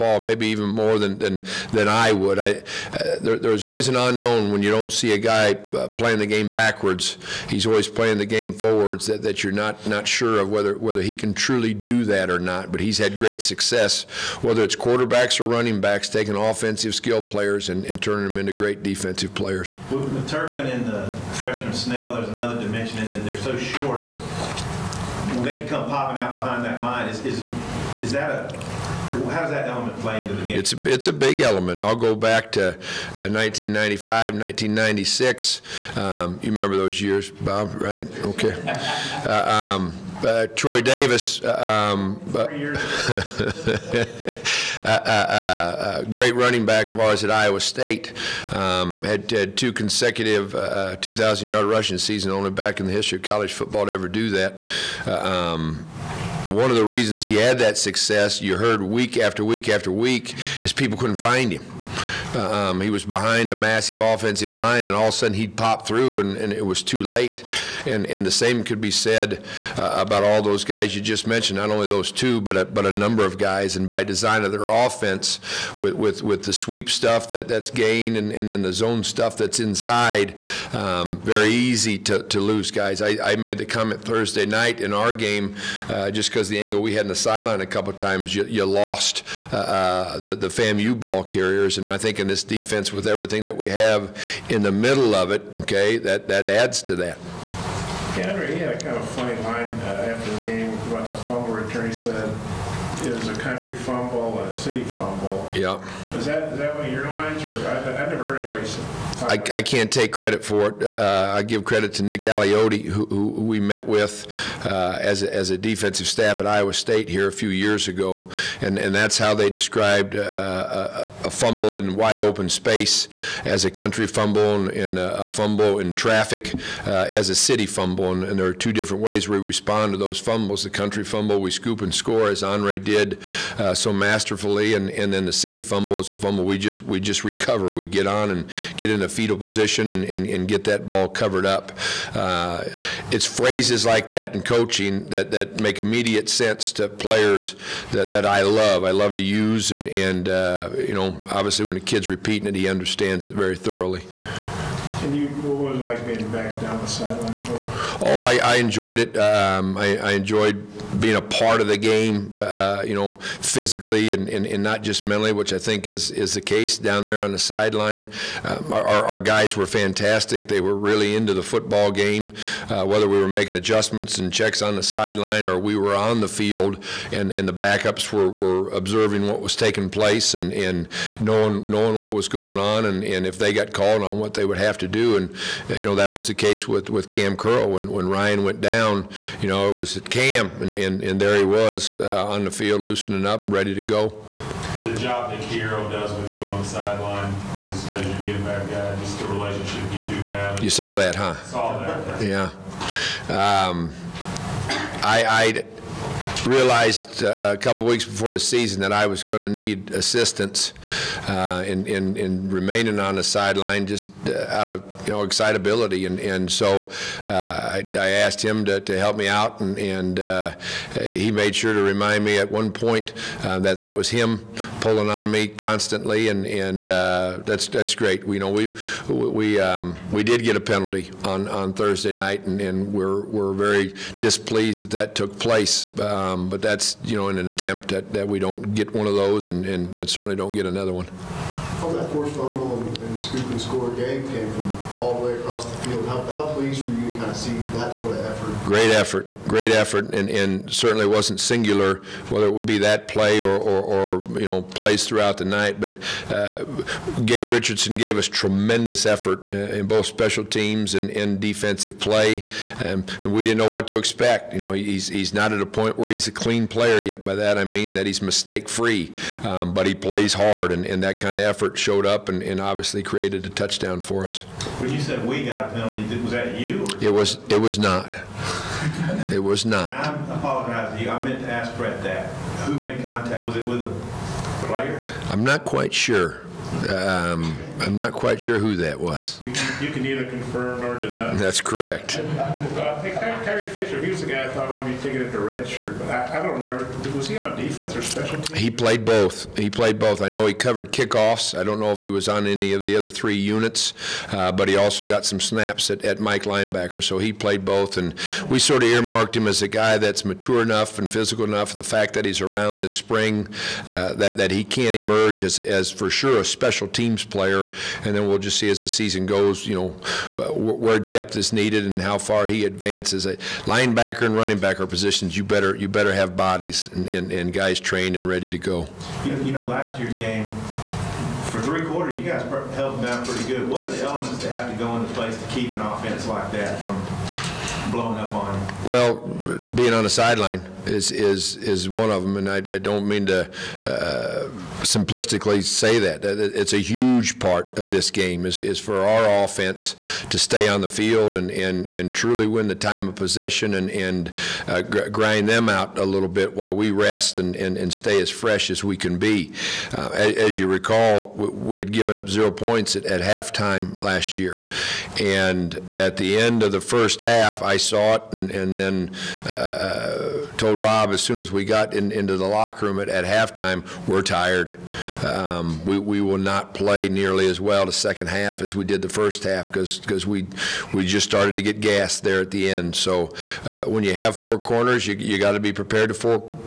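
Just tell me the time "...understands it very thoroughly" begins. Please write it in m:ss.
2:32.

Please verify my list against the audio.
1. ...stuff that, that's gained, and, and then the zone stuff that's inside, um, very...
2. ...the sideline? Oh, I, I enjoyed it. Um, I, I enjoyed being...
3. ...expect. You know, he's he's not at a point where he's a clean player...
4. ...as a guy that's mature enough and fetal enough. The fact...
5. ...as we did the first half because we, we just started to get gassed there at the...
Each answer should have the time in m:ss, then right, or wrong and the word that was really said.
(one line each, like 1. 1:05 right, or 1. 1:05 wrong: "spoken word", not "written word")
1. 1:16 right
2. 2:36 right
3. 4:23 right
4. 5:09 wrong: "physical", not "fetal"
5. 6:18 right.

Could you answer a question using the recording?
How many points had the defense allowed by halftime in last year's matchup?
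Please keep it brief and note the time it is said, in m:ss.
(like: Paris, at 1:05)
0, at 6:02.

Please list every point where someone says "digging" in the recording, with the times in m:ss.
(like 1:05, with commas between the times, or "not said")
not said.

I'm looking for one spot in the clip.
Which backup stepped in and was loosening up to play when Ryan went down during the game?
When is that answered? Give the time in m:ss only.
3:07.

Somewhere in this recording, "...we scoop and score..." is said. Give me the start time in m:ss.
2:11.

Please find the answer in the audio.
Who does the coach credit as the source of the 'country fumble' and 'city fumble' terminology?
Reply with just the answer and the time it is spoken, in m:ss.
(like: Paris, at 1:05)
Nick Aliotti, at 1:52.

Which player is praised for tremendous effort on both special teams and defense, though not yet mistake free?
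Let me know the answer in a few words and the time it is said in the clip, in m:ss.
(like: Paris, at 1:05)
Gabe Richardson, at 4:17.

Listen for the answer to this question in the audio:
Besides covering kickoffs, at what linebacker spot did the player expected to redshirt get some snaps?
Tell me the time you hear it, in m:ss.
5:06.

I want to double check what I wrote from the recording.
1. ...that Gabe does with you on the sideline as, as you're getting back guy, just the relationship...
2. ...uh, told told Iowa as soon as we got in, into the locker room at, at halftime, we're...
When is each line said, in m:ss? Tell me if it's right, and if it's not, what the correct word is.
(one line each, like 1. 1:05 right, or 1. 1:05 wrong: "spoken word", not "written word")
1. 3:15 wrong: "Kiro", not "Gabe"
2. 6:09 wrong: "Rob", not "Iowa".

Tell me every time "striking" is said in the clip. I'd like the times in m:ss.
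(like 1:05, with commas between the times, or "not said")
not said.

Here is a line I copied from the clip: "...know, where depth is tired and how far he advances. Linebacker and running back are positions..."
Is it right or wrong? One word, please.
wrong.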